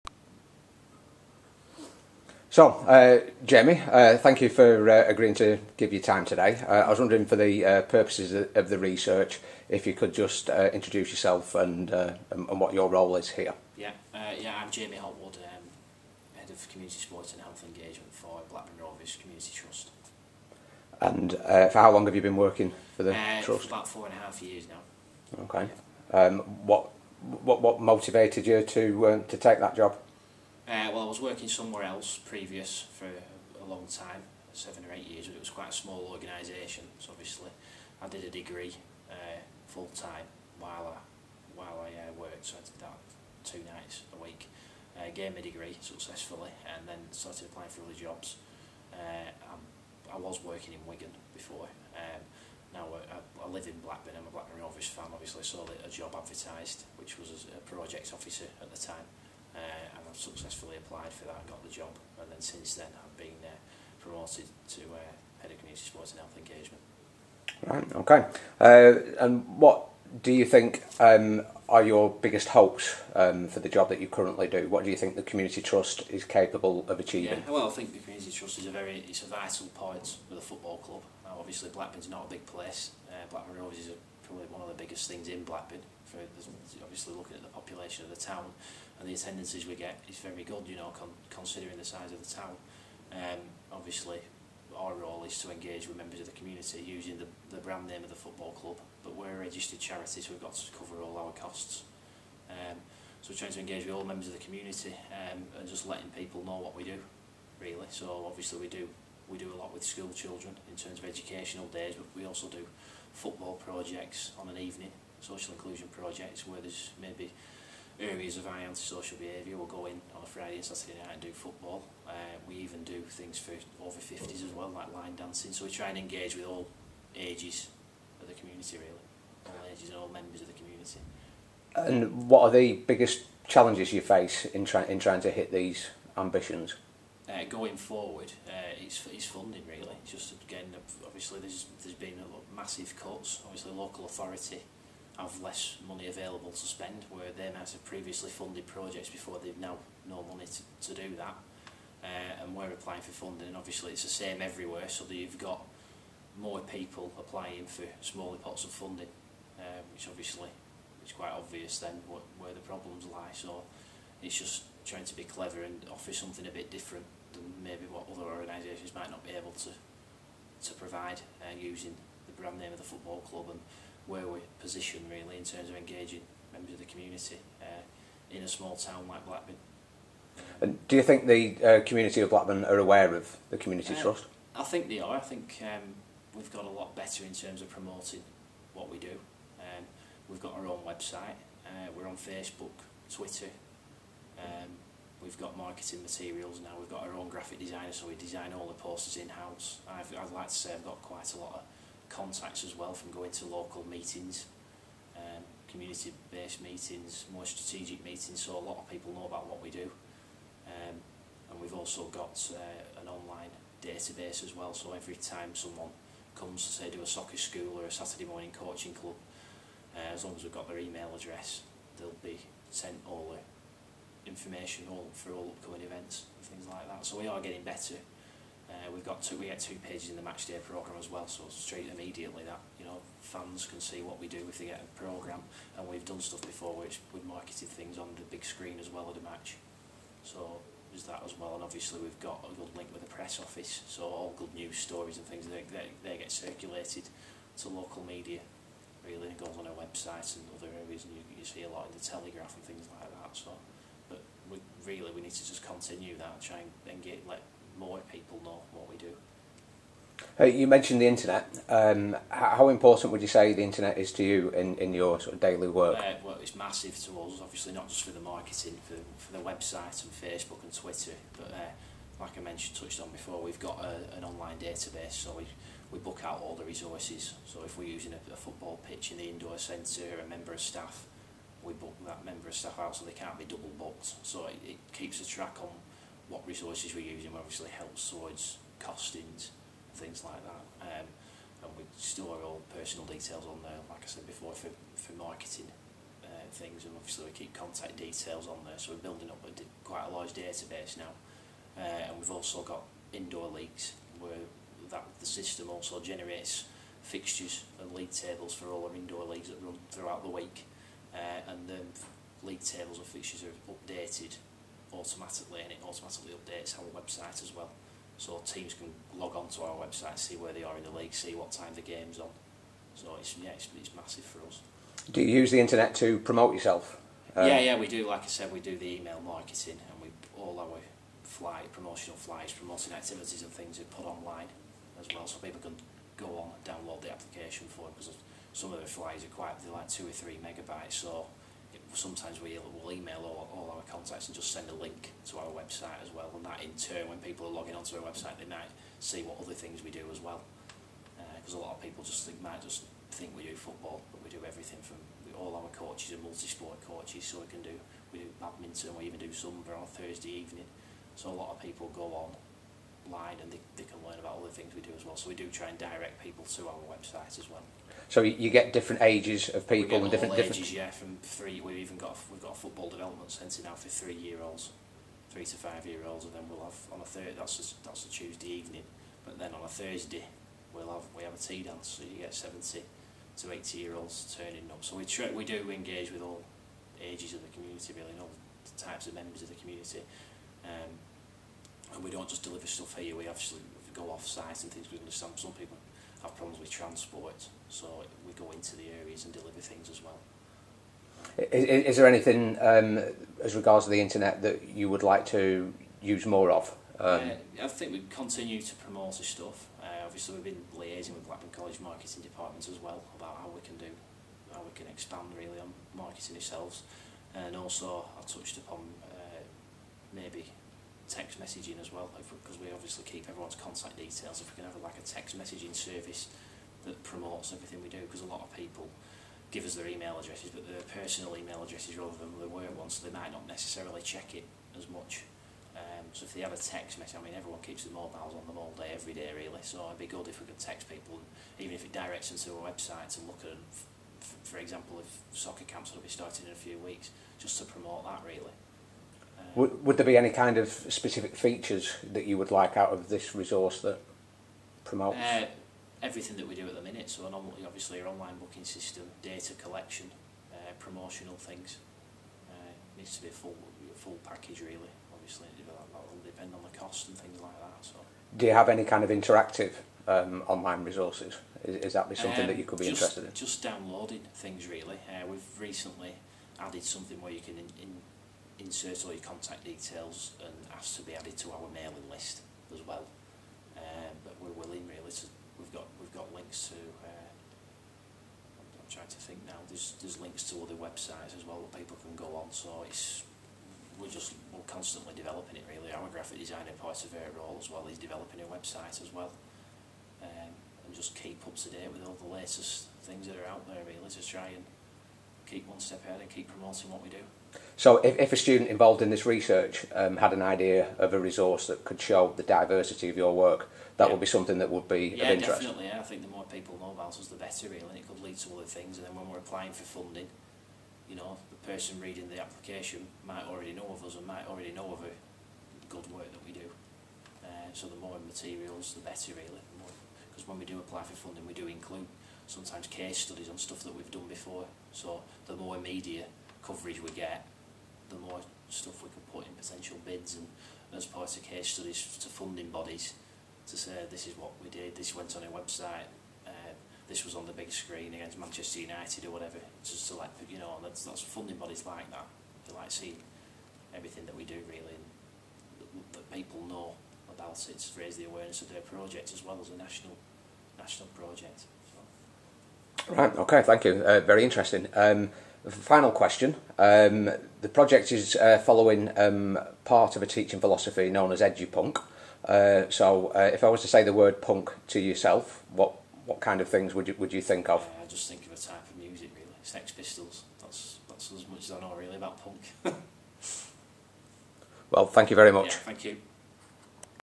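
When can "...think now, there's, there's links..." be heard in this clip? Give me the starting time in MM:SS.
08:09.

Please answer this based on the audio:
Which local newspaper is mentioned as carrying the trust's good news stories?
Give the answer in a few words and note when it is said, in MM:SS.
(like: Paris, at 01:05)
the Telegraph, at 04:12.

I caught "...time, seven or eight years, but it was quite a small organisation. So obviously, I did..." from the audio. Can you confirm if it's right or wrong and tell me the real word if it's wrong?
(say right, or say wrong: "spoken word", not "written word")
right.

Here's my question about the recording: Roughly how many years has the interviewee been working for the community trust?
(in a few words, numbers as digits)
four and a half years.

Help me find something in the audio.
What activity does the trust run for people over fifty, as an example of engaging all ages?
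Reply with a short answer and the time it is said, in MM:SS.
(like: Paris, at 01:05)
line dancing, at 02:04.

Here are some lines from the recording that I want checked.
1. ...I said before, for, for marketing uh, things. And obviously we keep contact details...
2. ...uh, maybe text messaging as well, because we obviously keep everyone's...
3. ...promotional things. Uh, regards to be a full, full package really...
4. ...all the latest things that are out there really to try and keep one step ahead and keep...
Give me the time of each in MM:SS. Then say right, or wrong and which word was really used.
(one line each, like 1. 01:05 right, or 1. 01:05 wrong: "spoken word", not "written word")
1. 04:54 right
2. 06:59 right
3. 07:40 wrong: "needs", not "regards"
4. 08:22 right.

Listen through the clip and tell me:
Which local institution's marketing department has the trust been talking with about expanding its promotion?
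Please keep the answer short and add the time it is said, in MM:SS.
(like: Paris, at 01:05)
Blackburn College, at 06:51.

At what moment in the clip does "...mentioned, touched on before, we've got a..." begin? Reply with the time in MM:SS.
04:32.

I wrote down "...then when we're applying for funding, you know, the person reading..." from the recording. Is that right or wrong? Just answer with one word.
right.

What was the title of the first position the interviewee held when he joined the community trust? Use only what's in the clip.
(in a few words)
project officer.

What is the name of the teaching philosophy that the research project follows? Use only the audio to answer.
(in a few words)
edupunk.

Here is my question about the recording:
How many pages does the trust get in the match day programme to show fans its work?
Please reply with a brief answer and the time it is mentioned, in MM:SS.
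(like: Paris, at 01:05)
2, at 03:49.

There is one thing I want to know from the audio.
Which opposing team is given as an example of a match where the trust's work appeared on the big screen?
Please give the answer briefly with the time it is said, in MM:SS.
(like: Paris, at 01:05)
Manchester United, at 09:08.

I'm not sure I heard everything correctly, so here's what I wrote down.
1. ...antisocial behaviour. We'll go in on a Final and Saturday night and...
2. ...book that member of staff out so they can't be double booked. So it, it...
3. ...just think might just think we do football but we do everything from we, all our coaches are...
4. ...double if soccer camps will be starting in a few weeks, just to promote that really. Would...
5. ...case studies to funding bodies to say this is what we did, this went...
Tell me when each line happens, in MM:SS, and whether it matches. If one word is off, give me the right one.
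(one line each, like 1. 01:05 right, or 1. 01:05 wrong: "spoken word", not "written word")
1. 01:58 wrong: "Friday", not "Final"
2. 04:41 right
3. 05:52 right
4. 07:24 wrong: "example", not "double"
5. 09:01 right.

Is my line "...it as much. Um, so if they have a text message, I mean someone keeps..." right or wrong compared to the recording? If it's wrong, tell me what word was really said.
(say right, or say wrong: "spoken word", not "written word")
wrong: "everyone", not "someone".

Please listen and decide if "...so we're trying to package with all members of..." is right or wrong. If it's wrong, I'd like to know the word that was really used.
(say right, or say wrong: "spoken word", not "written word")
wrong: "engage", not "package".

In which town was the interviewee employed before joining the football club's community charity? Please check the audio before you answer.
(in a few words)
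Wigan.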